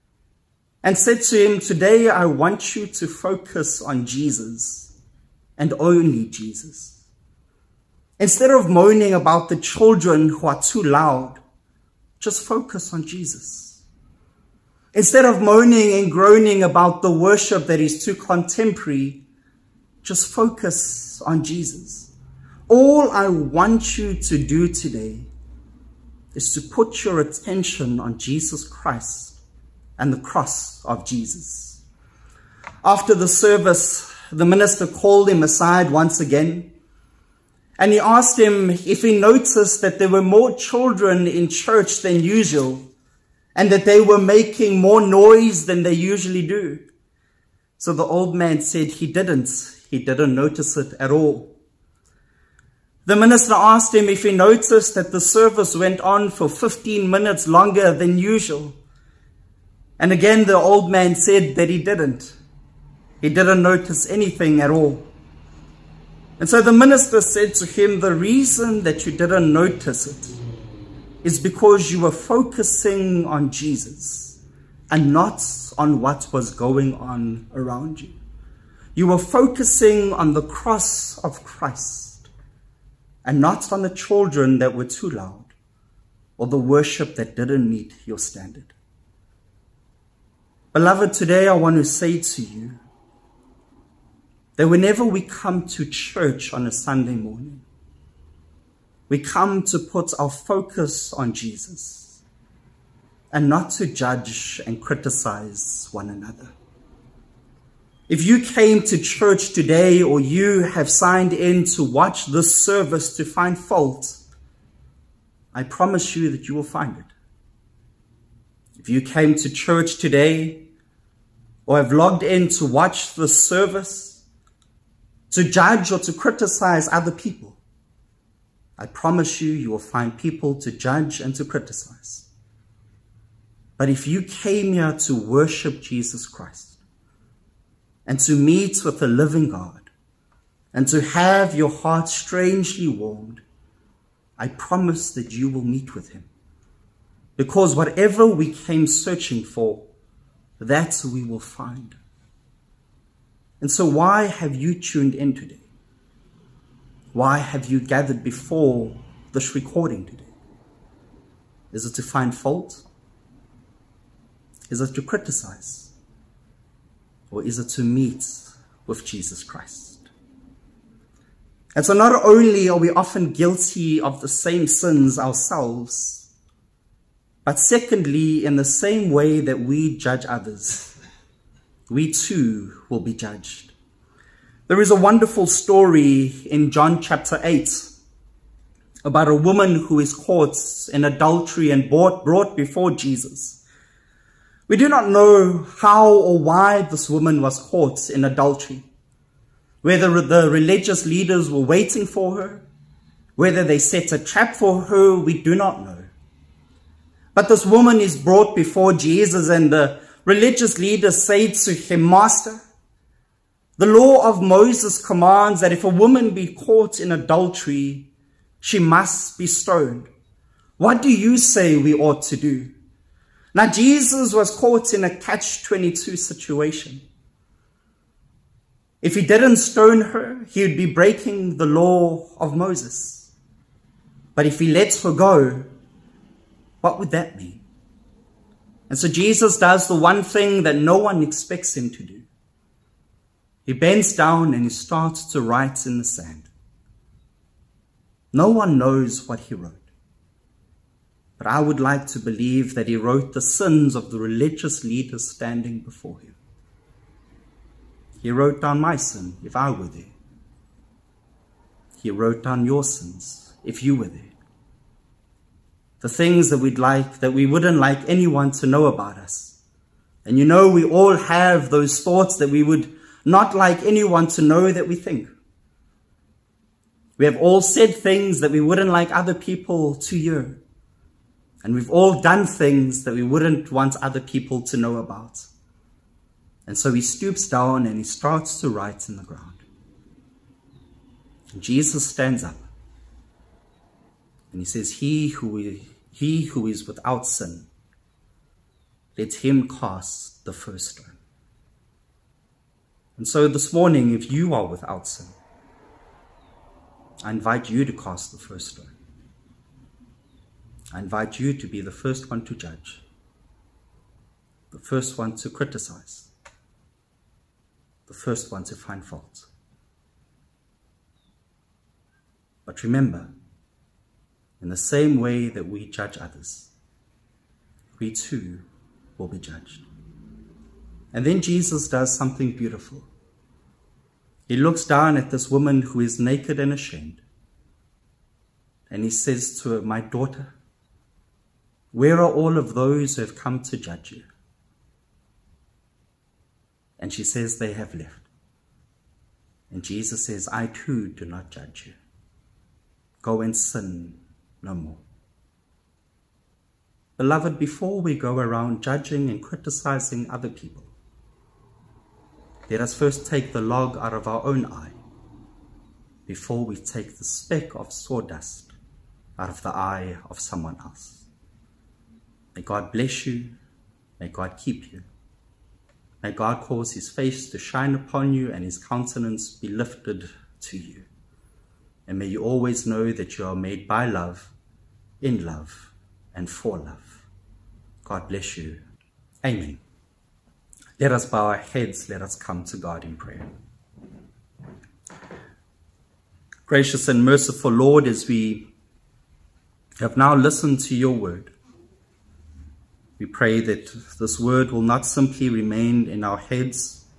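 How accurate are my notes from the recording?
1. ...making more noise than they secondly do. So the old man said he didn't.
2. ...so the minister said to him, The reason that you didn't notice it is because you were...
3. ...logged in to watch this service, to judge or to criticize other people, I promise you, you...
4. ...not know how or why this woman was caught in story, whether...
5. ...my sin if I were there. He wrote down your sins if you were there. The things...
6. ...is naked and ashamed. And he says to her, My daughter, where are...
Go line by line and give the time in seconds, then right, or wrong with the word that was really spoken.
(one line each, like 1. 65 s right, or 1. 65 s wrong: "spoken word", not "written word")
1. 44 s wrong: "usually", not "secondly"
2. 66 s right
3. 121 s right
4. 194 s wrong: "adultery", not "story"
5. 258 s right
6. 336 s right.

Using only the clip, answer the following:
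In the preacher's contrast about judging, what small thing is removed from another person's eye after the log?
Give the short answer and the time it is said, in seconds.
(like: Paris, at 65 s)
Speck of sawdust, at 367 s.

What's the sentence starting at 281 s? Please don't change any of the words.
And we've all done things that we wouldn't want other people to know about.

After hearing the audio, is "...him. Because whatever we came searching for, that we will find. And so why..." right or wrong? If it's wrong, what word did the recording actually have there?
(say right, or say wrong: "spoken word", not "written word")
right.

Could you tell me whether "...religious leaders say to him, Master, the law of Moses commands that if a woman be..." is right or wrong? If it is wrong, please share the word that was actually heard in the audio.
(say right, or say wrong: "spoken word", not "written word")
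right.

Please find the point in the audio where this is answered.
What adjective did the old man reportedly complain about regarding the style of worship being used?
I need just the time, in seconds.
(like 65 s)
18 s.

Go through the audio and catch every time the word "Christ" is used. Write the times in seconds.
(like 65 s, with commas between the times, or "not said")
28 s, 81 s, 136 s, 169 s.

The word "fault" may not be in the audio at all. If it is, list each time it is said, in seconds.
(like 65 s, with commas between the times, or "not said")
113 s, 162 s, 319 s.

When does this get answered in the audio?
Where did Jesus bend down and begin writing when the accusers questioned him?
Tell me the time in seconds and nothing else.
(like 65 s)
245 s.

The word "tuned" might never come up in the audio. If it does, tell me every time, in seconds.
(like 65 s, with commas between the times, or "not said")
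154 s.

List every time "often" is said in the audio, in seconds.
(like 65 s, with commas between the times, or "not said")
172 s.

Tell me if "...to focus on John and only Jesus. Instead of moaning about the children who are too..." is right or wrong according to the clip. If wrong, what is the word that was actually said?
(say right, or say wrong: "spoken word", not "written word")
wrong: "Jesus", not "John".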